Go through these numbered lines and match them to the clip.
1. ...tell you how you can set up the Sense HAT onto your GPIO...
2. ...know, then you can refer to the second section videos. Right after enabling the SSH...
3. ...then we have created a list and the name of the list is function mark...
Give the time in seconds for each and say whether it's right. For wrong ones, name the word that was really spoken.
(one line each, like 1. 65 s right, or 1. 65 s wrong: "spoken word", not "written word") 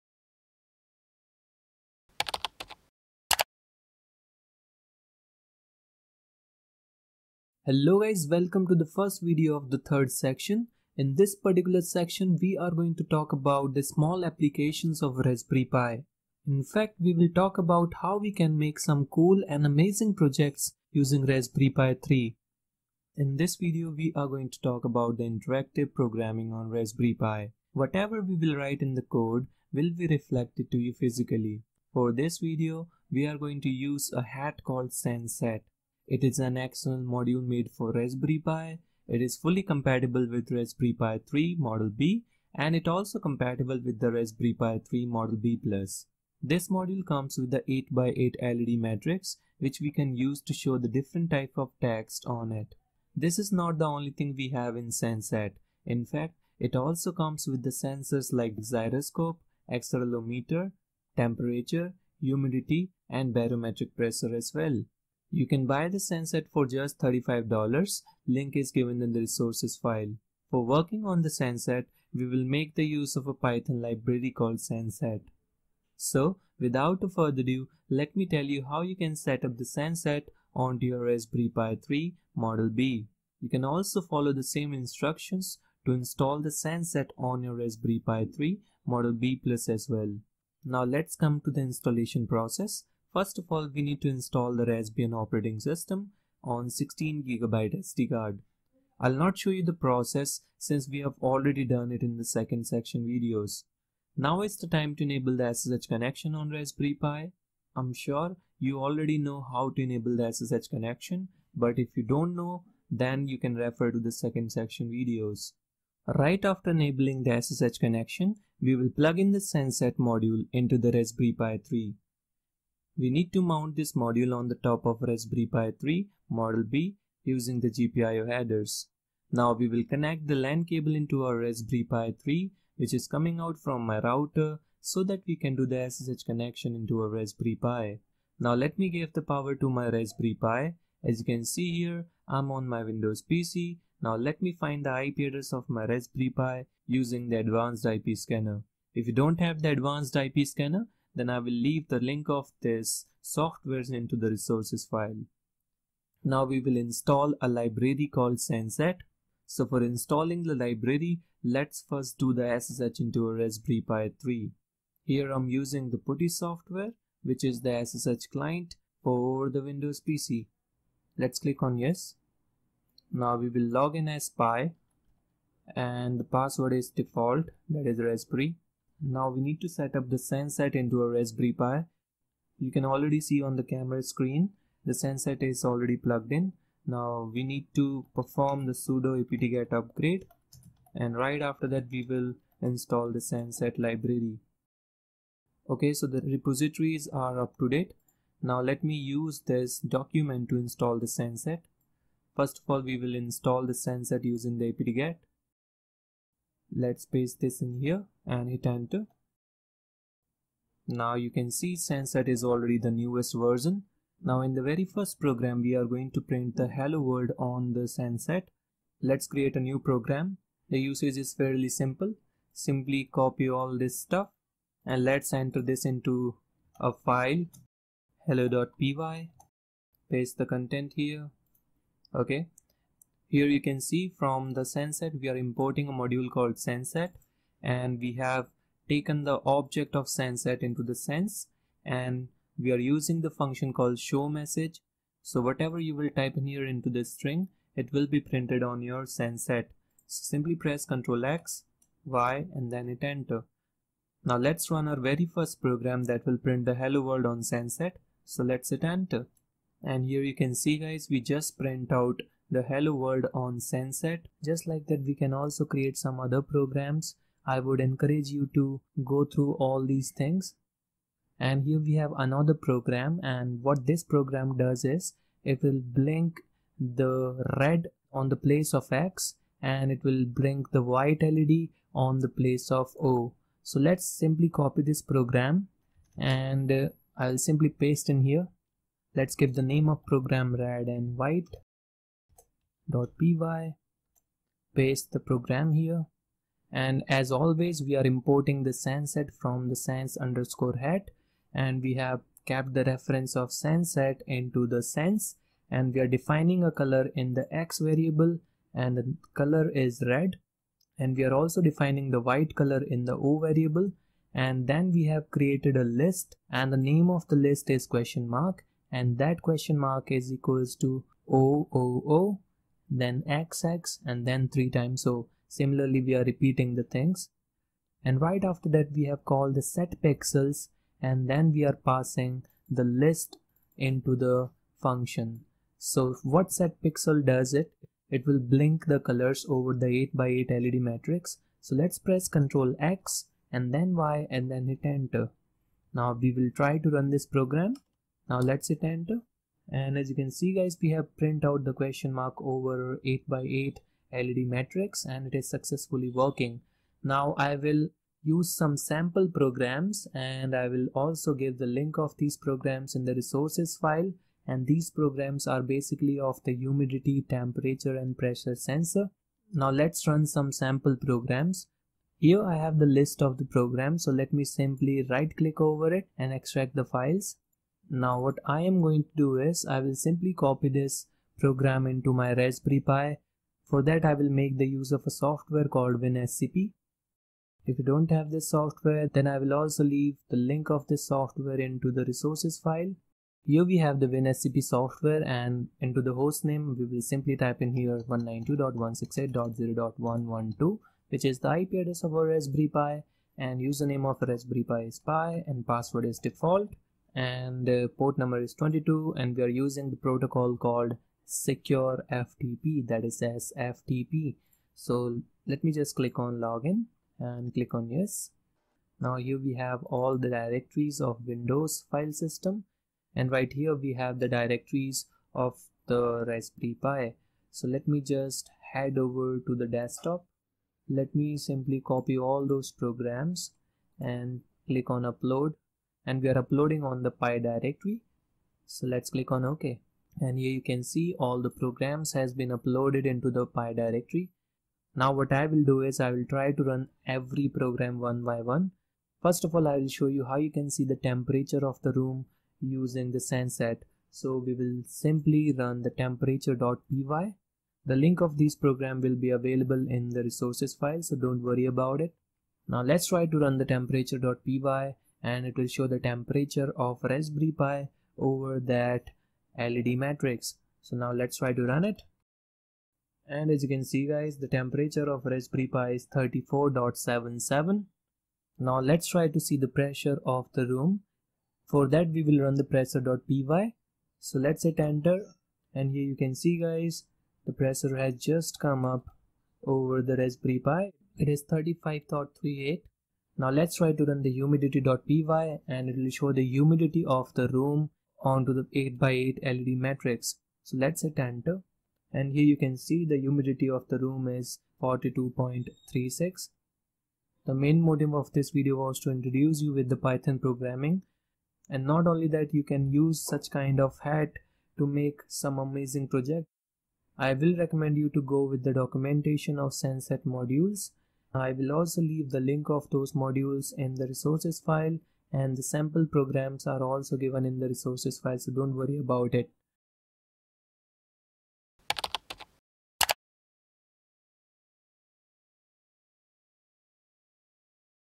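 1. 78 s wrong: "Raspberry", not "GPIO"
2. 112 s right
3. 314 s wrong: "question", not "function".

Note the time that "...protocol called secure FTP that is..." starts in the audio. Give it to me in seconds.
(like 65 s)
409 s.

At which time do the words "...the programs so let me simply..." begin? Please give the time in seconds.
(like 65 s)
373 s.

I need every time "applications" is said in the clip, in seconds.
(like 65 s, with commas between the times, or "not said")
14 s.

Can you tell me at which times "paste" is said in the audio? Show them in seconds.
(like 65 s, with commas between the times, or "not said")
207 s, 230 s, 287 s, 294 s.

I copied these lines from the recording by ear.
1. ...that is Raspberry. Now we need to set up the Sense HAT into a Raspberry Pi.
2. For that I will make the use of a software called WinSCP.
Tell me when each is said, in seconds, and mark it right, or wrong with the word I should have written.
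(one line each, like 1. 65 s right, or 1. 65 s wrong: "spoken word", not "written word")
1. 177 s right
2. 383 s right.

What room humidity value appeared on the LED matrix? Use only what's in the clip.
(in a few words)
42.36.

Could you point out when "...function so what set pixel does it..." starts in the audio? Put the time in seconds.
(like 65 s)
334 s.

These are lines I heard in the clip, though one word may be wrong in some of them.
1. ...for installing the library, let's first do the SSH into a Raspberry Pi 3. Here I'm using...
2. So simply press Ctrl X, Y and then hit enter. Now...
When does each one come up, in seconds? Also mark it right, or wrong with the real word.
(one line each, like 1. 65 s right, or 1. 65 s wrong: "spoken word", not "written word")
1. 159 s right
2. 250 s right.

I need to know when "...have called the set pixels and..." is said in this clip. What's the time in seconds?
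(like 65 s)
329 s.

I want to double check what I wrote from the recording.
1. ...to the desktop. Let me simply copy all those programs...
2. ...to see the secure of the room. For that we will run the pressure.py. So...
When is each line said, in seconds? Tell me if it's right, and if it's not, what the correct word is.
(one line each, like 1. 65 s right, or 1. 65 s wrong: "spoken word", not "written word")
1. 429 s right
2. 479 s wrong: "pressure", not "secure".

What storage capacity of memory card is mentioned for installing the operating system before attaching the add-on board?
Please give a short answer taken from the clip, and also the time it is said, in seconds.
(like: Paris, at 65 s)
16GB, at 96 s.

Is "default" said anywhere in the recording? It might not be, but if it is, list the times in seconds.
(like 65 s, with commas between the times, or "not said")
176 s, 406 s.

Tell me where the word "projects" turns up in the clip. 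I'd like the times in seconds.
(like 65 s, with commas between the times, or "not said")
20 s, 516 s.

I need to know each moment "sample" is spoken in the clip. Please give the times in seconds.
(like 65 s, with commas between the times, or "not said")
358 s, 370 s, 525 s.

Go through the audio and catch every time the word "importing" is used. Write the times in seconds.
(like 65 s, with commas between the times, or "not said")
235 s, 298 s.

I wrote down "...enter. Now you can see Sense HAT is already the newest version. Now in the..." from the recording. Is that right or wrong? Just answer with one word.
right.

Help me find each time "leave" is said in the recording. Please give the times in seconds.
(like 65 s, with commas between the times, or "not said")
151 s, 389 s, 522 s.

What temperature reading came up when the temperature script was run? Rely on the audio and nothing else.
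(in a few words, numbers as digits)
34.77.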